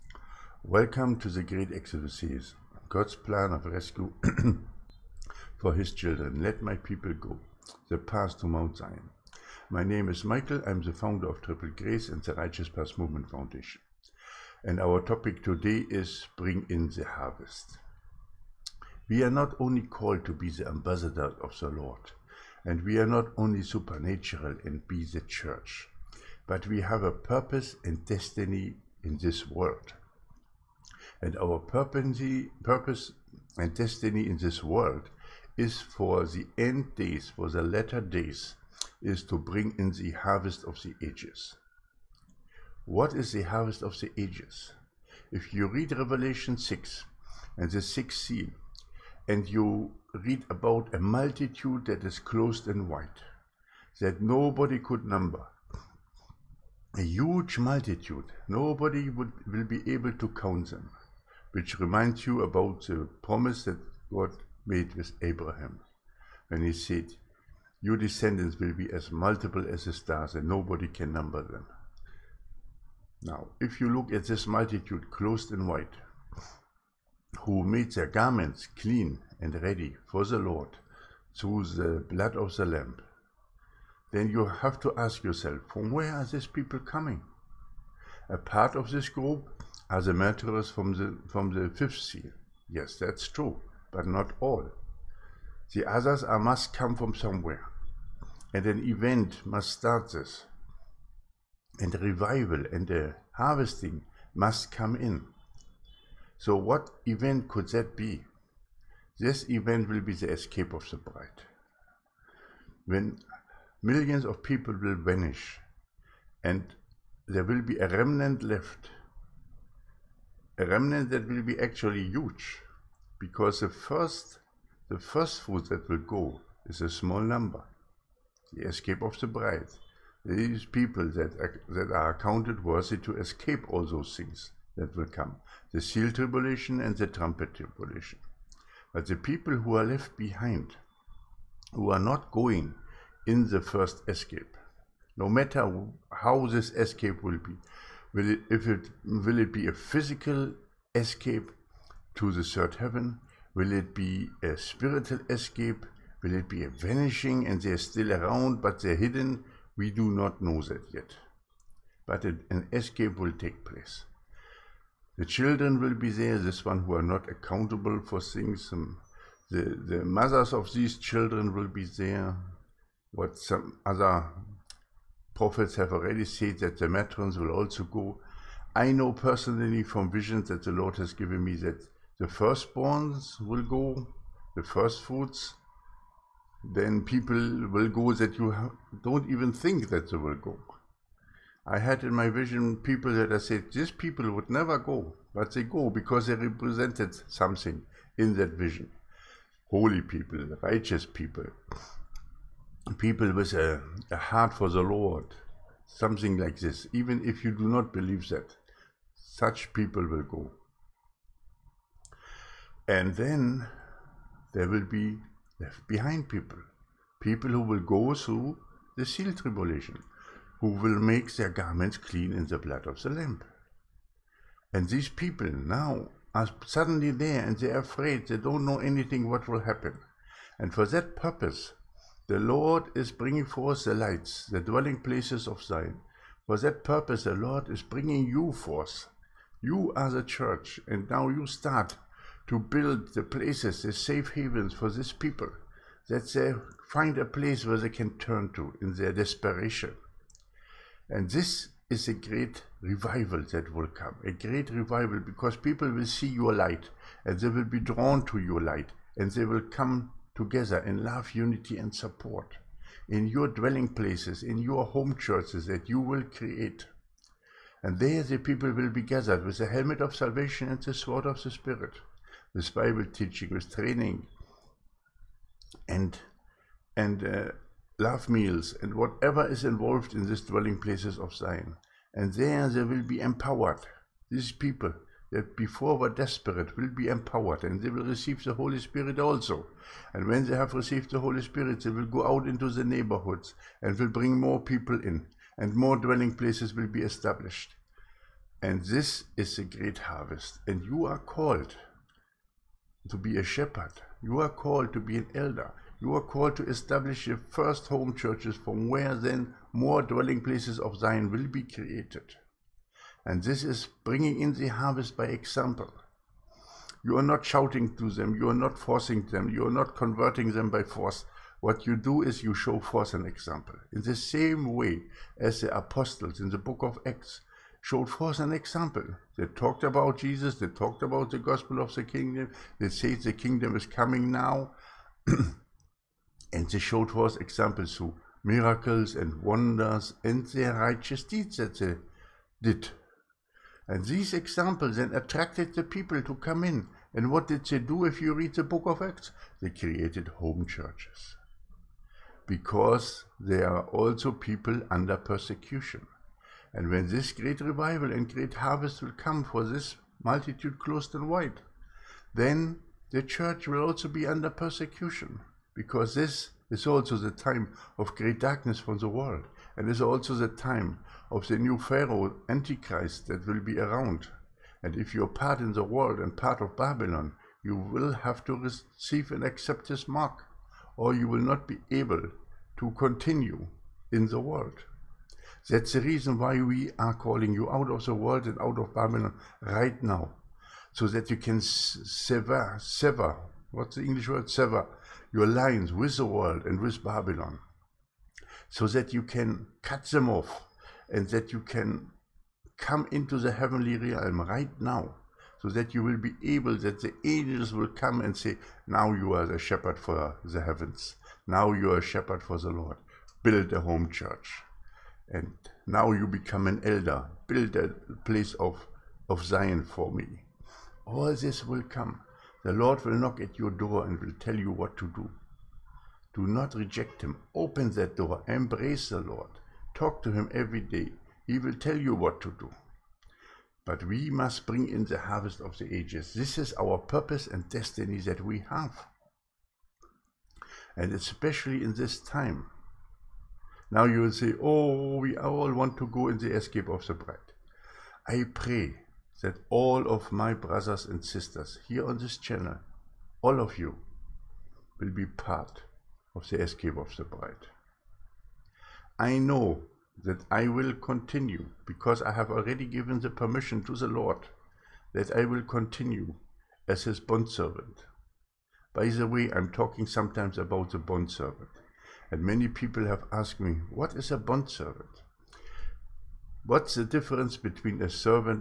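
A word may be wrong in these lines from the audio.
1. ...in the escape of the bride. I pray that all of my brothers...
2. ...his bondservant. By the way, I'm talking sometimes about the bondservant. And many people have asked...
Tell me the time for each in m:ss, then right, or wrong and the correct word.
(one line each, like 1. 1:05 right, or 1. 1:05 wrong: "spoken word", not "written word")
1. 7:26 right
2. 7:47 right.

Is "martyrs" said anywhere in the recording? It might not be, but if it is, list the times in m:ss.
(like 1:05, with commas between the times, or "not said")
1:30.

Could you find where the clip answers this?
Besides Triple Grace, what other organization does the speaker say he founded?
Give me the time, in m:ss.
0:12.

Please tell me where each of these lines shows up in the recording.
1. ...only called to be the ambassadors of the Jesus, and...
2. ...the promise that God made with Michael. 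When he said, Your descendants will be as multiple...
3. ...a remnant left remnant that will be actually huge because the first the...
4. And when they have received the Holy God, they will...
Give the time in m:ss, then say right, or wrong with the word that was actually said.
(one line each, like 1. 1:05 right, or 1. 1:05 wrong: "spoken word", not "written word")
1. 0:19 wrong: "Lord", not "Jesus"
2. 1:02 wrong: "Abraham", not "Michael"
3. 1:57 right
4. 4:50 wrong: "Spirit", not "God".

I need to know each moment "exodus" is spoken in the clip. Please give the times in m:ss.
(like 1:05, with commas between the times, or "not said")
0:01.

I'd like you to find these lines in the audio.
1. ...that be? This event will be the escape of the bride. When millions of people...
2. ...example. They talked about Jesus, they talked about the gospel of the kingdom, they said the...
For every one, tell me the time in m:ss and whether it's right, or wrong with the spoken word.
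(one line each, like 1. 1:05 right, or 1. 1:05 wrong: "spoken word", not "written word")
1. 1:47 right
2. 5:28 right.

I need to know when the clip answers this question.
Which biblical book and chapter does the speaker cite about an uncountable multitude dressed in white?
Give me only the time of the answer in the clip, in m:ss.
0:45.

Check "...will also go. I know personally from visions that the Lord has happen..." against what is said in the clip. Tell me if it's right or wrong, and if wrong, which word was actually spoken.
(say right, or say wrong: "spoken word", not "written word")
wrong: "given", not "happen".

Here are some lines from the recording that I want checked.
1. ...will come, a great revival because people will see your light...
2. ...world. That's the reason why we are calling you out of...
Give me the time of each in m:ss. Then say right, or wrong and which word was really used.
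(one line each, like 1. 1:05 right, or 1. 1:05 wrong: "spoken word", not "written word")
1. 4:13 right
2. 6:24 right.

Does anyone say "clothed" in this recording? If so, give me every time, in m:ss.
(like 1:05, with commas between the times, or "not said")
0:52, 1:15.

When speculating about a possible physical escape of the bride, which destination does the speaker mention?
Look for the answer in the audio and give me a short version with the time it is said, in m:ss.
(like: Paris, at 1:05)
third heaven, at 2:32.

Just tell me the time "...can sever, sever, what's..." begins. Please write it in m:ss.
6:31.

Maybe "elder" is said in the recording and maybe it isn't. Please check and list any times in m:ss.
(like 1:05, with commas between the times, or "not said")
5:05, 6:56.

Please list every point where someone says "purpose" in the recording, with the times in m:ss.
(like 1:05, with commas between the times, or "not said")
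0:27, 0:31, 3:51, 3:56, 7:16.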